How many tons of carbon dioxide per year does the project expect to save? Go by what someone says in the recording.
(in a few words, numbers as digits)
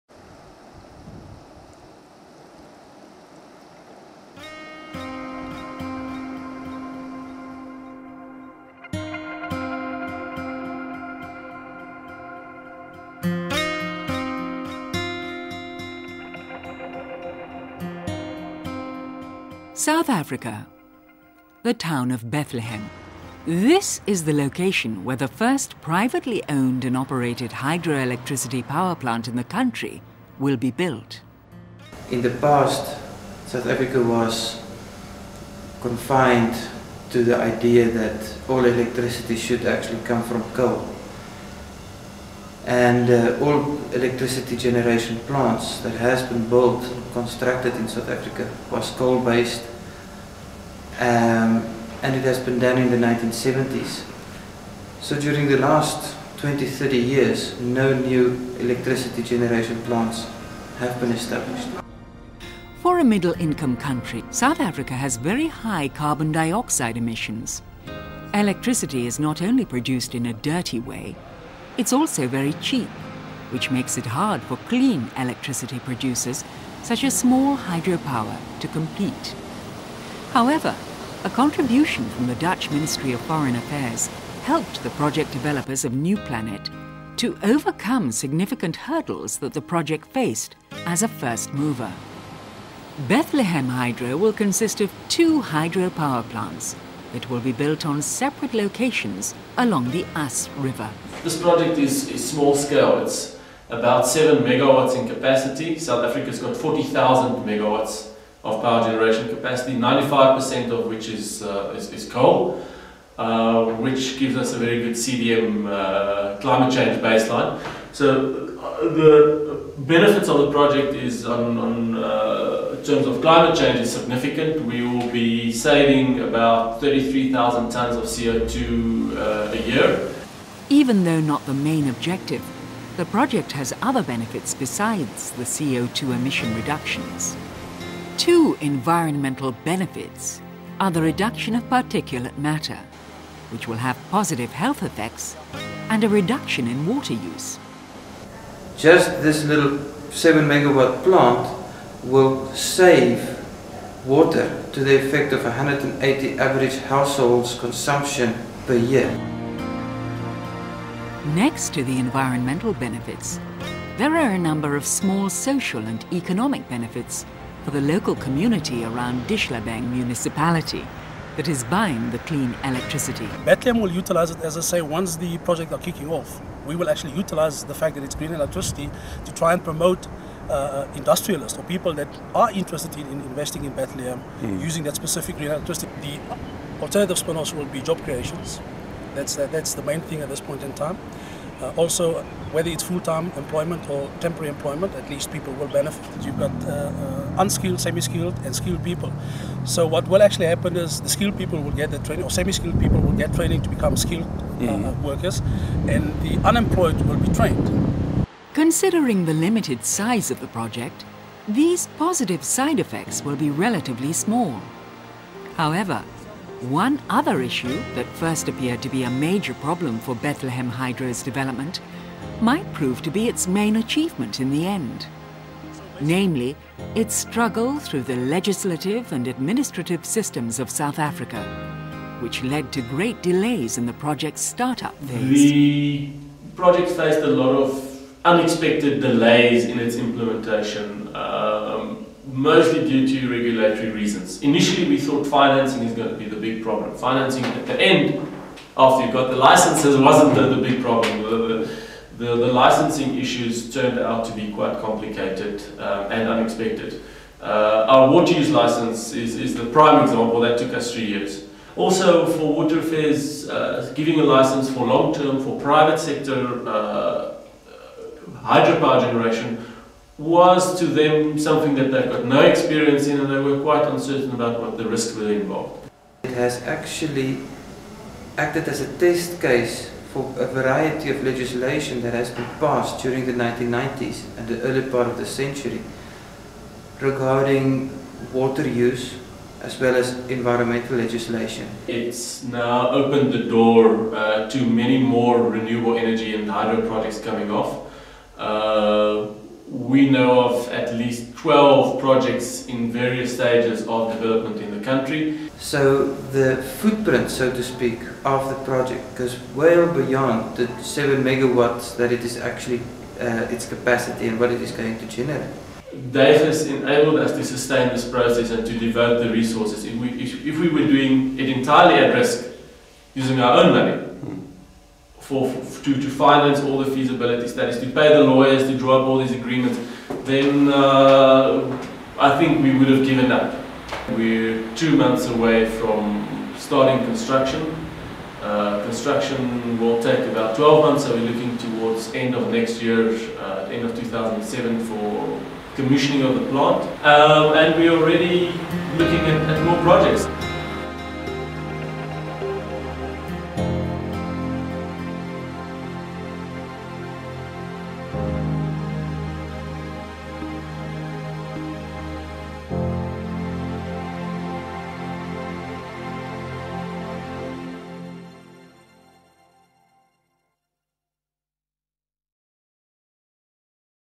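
33,000.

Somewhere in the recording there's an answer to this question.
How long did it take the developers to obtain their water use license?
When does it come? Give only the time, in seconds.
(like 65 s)
260 s.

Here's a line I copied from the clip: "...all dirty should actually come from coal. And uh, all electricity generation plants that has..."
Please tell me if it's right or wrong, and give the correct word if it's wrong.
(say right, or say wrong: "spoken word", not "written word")
wrong: "electricity", not "dirty".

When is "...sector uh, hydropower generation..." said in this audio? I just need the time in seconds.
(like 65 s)
265 s.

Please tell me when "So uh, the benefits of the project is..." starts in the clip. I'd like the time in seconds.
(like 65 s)
117 s.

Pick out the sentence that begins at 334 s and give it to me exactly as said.
We're two months away from starting construction.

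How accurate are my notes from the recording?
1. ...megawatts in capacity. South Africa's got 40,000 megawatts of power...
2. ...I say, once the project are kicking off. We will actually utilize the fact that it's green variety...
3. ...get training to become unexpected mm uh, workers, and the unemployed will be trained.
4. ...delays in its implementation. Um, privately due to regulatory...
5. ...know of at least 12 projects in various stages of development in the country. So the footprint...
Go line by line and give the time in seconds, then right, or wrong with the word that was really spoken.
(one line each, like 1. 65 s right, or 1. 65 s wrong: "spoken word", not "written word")
1. 104 s right
2. 174 s wrong: "electricity", not "variety"
3. 203 s wrong: "skilled", not "unexpected"
4. 239 s wrong: "mostly", not "privately"
5. 300 s right.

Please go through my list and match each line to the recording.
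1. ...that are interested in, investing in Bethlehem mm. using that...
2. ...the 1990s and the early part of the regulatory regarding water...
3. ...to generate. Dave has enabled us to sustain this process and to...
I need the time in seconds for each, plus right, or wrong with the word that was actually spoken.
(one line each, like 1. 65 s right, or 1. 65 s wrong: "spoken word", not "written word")
1. 181 s right
2. 283 s wrong: "century", not "regulatory"
3. 314 s right.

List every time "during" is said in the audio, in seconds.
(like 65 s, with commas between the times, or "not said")
55 s, 283 s.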